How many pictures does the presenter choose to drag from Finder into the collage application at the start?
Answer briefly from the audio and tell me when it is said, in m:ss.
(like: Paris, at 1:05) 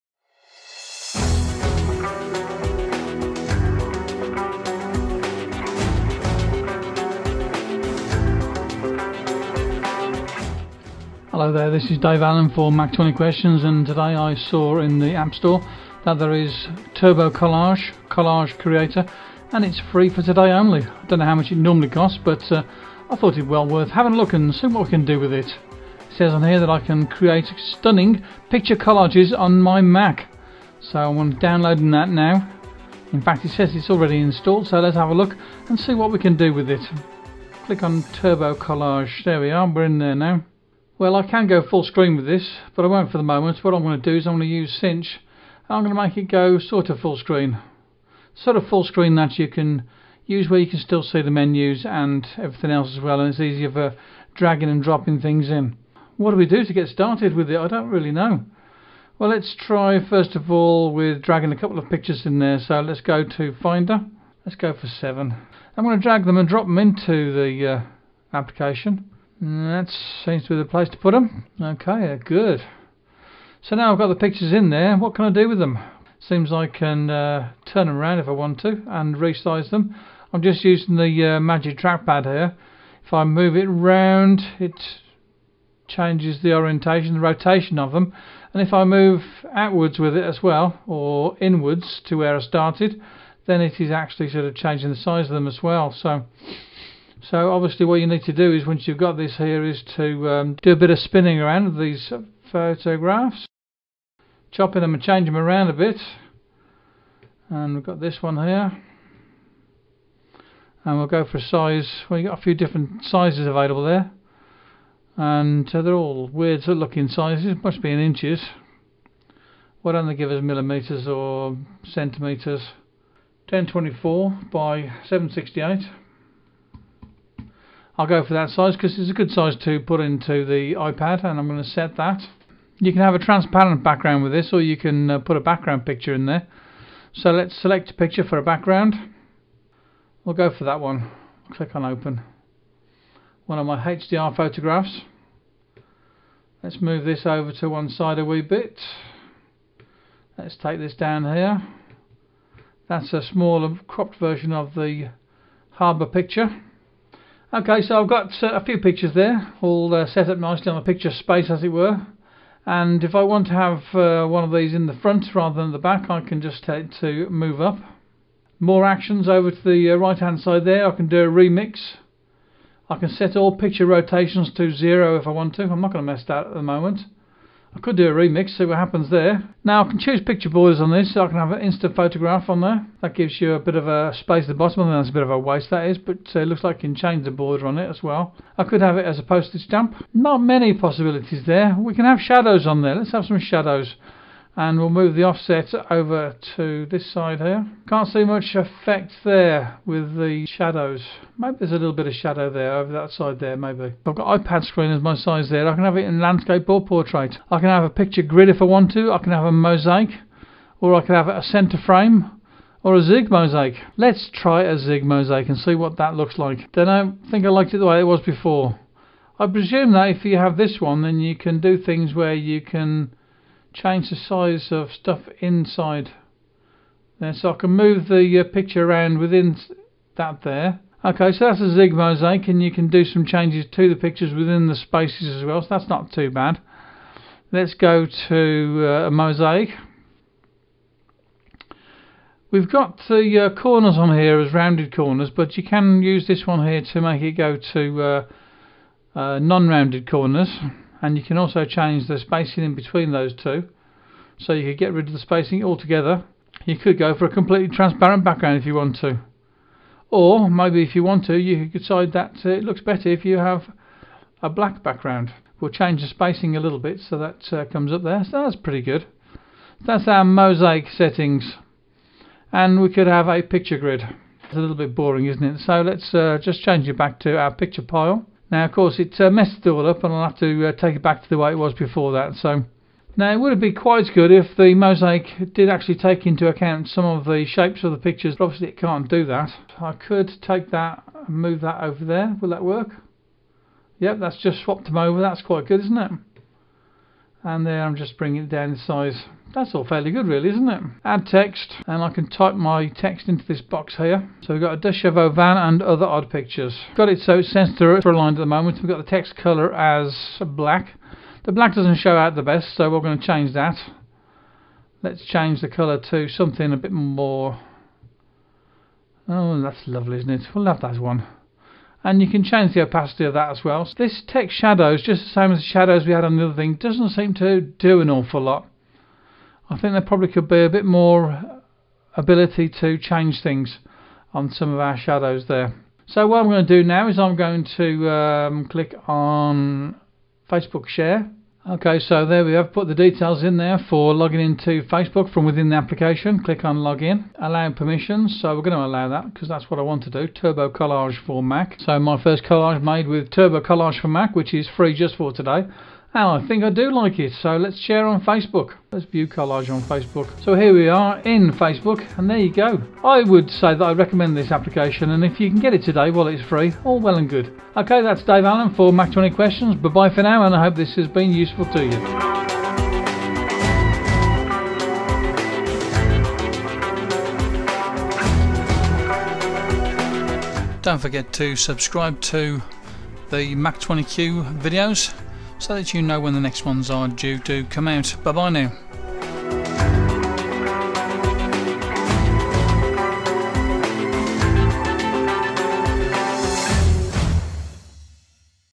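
7, at 1:04.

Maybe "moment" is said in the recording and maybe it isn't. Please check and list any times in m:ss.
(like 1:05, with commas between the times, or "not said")
0:43, 2:56, 5:08.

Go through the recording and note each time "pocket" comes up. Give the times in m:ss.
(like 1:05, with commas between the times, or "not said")
not said.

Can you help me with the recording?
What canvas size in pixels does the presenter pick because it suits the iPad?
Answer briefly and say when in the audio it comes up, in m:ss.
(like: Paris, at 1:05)
1024 by 768, at 2:03.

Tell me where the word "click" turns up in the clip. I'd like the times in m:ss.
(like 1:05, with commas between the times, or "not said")
0:37, 2:21, 5:38, 5:46.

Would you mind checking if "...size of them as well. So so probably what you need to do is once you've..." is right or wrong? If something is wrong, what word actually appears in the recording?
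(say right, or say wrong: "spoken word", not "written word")
wrong: "obviously", not "probably".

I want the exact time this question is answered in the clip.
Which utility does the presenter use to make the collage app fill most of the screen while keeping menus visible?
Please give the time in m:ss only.
0:44.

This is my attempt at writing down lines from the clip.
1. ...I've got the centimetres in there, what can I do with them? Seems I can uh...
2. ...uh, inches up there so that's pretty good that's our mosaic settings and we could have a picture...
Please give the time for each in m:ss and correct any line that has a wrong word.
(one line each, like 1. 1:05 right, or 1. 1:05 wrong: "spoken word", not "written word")
1. 1:13 wrong: "pictures", not "centimetres"
2. 4:27 wrong: "comes", not "inches".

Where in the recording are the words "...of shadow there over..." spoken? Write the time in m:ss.
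3:22.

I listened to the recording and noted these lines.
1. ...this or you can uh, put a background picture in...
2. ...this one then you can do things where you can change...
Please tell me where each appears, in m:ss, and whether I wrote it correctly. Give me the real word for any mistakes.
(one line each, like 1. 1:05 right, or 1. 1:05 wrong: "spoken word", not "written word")
1. 2:14 right
2. 3:40 right.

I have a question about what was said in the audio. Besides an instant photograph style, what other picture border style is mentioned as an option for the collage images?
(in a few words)
Postage stamp.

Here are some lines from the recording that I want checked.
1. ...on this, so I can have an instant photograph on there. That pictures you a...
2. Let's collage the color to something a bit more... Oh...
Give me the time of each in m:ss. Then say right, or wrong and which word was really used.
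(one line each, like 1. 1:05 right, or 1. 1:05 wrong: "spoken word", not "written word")
1. 3:00 wrong: "gives", not "pictures"
2. 5:15 wrong: "change", not "collage".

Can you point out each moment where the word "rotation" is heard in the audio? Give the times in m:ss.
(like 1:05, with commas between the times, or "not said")
1:27, 2:53.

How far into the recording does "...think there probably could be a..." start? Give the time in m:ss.
5:29.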